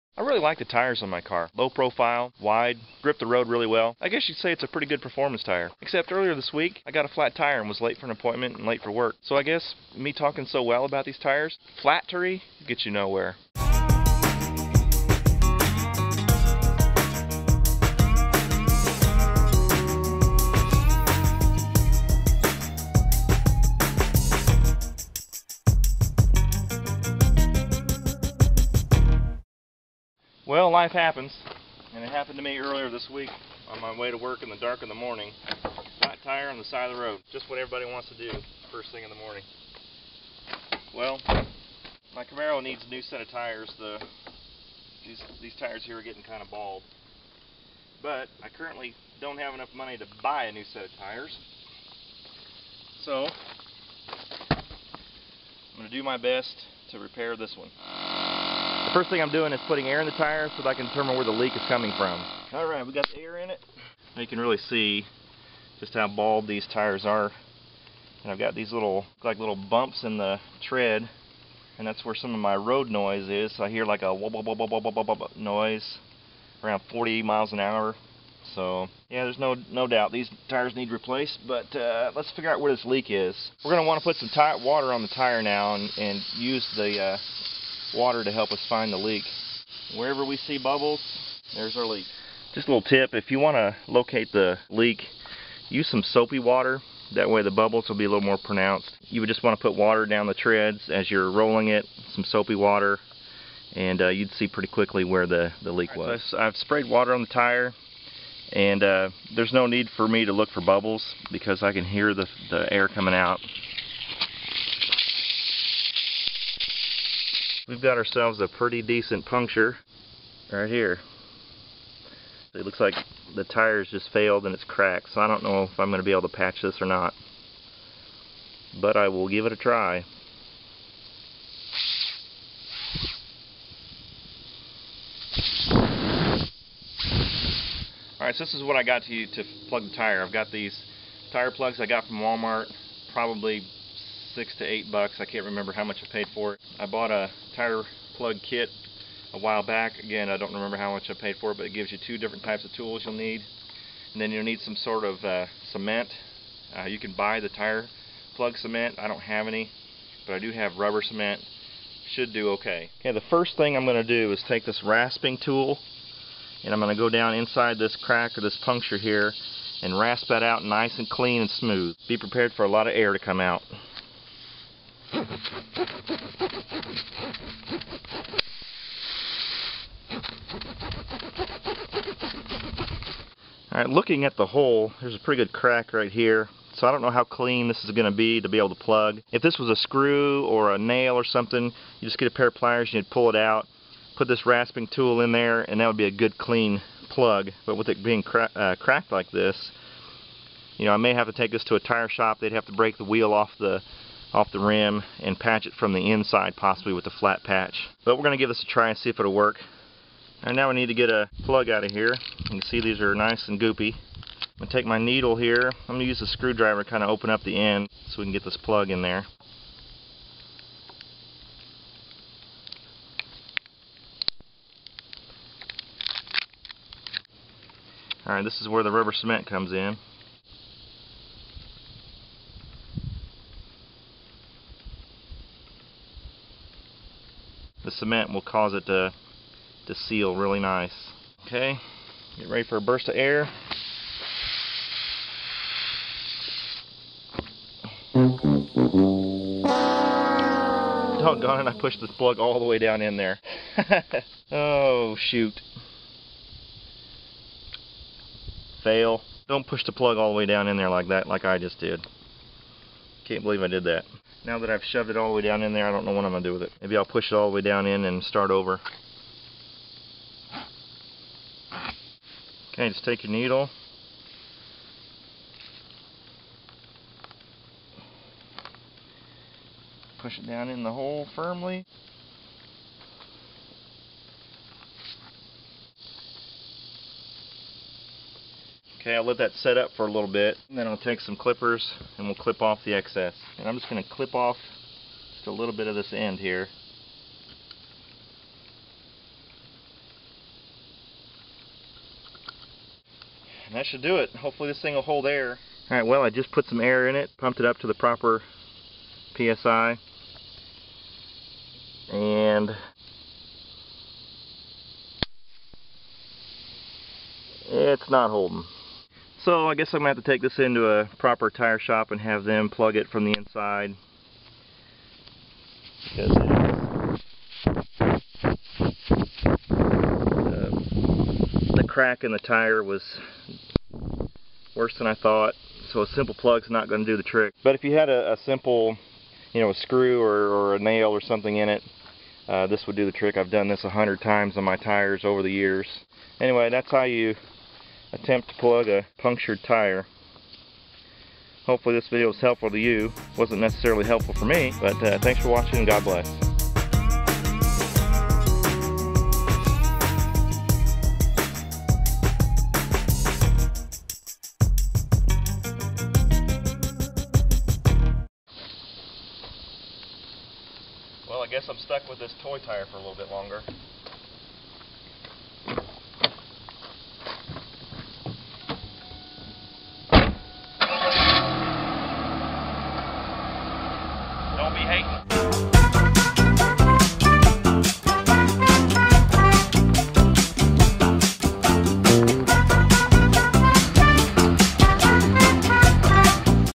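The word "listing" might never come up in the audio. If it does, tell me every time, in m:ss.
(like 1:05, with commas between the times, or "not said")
not said.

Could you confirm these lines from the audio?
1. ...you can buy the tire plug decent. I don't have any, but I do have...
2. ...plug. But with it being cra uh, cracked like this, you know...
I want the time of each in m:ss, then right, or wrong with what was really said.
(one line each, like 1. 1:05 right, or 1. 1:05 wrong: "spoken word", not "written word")
1. 2:36 wrong: "cement", not "decent"
2. 3:17 right.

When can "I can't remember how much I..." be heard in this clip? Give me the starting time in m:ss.
2:25.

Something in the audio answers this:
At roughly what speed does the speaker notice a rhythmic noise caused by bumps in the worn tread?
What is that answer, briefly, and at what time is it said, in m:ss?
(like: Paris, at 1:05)
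40 miles an hour, at 1:16.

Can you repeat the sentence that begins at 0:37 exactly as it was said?
Just what everybody wants to do first thing in the morning.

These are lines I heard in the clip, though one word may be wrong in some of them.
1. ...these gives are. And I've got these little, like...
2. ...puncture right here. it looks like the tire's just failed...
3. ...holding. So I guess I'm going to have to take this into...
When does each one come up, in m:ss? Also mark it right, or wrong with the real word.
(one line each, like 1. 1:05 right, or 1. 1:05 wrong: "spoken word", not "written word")
1. 1:06 wrong: "tires", not "gives"
2. 1:59 right
3. 5:18 right.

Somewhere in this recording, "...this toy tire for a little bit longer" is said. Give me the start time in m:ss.
6:12.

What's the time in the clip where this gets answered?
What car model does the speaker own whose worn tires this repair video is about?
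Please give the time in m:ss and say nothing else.
0:42.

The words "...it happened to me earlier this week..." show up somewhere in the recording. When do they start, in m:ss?
0:32.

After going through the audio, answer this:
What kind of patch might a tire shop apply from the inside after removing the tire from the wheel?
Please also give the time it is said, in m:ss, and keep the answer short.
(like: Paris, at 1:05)
flat patch, at 3:27.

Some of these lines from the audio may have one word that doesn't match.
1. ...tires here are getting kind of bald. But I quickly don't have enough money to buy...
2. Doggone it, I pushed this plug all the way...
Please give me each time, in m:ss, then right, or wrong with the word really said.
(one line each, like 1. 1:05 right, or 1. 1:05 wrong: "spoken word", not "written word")
1. 0:45 wrong: "currently", not "quickly"
2. 4:11 right.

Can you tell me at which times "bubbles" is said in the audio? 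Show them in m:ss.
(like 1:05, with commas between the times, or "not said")
1:30, 1:37, 1:50.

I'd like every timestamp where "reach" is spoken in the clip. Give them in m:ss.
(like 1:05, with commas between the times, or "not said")
not said.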